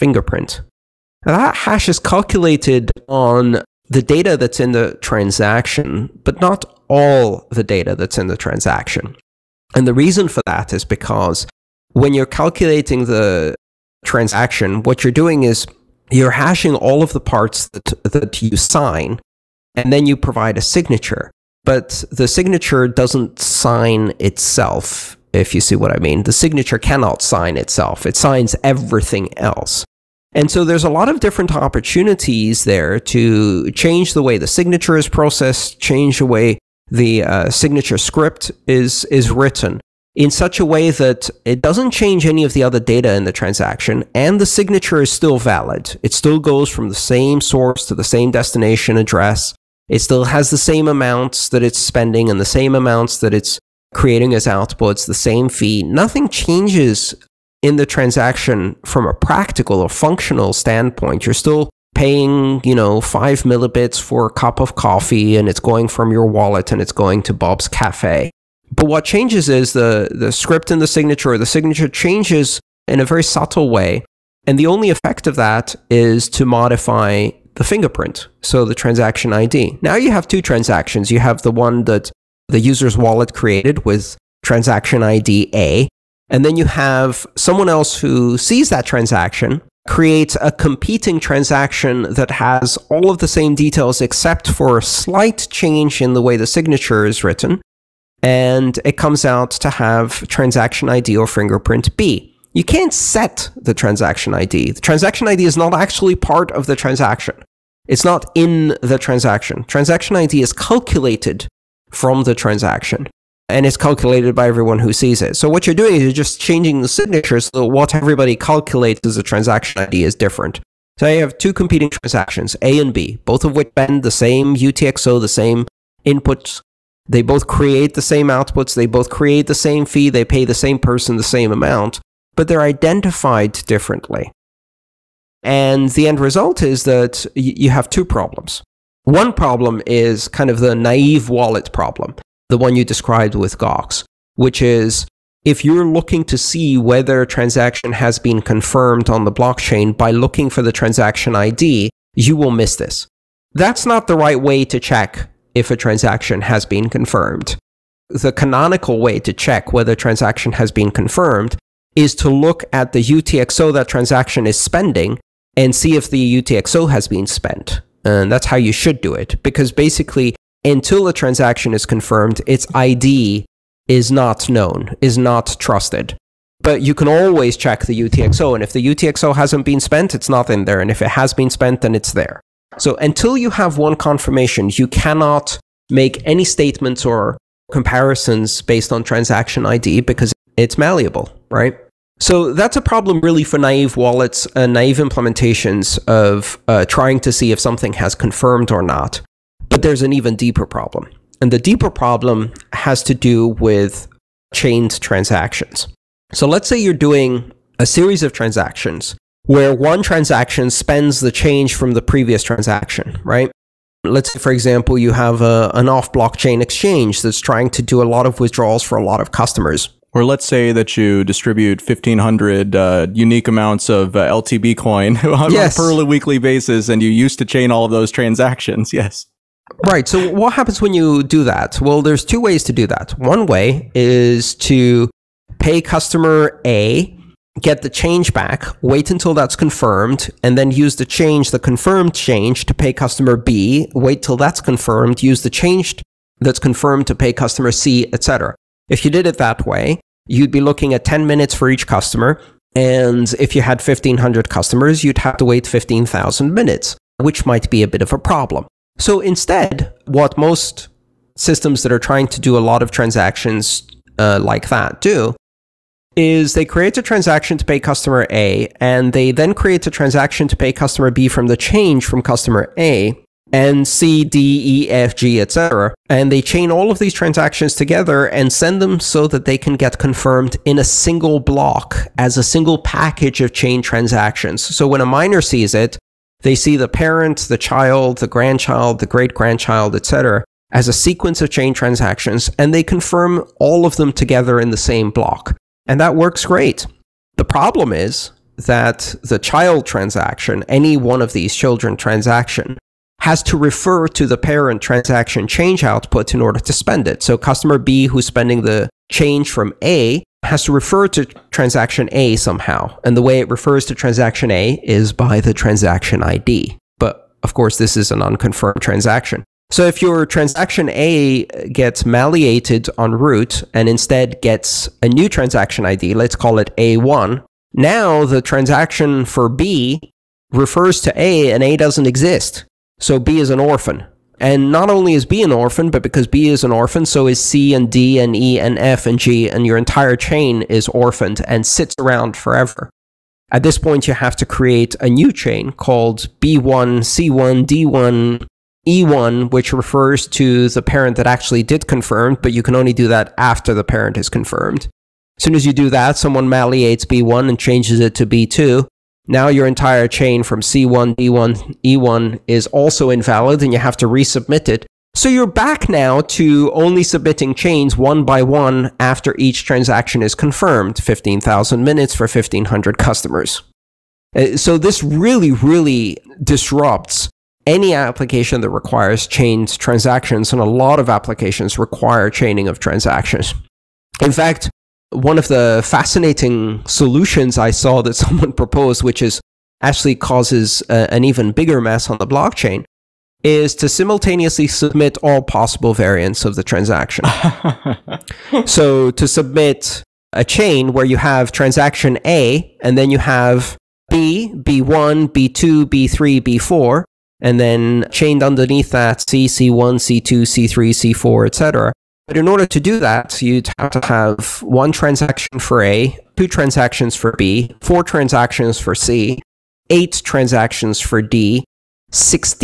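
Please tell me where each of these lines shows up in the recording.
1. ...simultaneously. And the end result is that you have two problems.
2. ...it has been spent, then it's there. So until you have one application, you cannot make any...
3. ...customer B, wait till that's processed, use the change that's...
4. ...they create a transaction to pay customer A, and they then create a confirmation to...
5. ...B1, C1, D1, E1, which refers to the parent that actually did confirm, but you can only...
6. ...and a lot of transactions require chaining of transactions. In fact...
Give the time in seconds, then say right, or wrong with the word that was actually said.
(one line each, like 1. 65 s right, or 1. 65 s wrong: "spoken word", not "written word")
1. 133 s wrong: "differently", not "simultaneously"
2. 181 s wrong: "confirmation", not "application"
3. 242 s wrong: "confirmed", not "processed"
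4. 266 s wrong: "transaction", not "confirmation"
5. 346 s right
6. 380 s wrong: "applications", not "transactions".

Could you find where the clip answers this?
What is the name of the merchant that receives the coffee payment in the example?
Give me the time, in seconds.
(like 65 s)
67 s.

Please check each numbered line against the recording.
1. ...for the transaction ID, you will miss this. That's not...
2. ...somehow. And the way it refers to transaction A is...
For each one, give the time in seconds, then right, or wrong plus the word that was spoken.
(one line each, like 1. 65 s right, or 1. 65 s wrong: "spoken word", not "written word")
1. 150 s right
2. 312 s right.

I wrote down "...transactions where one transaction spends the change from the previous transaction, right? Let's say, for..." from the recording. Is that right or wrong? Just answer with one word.
right.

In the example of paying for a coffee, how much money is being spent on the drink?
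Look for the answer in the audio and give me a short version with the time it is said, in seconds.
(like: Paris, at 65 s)
5 millibits, at 62 s.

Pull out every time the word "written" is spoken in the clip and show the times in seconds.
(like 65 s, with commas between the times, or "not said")
39 s, 97 s.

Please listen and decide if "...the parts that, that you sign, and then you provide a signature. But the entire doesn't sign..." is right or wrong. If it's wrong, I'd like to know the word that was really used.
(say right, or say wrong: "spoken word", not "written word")
wrong: "signature", not "entire".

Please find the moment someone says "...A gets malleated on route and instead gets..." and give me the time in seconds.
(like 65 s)
320 s.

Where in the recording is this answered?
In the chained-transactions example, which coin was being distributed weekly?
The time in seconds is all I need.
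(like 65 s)
224 s.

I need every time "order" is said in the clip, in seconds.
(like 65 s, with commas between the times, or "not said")
306 s, 412 s.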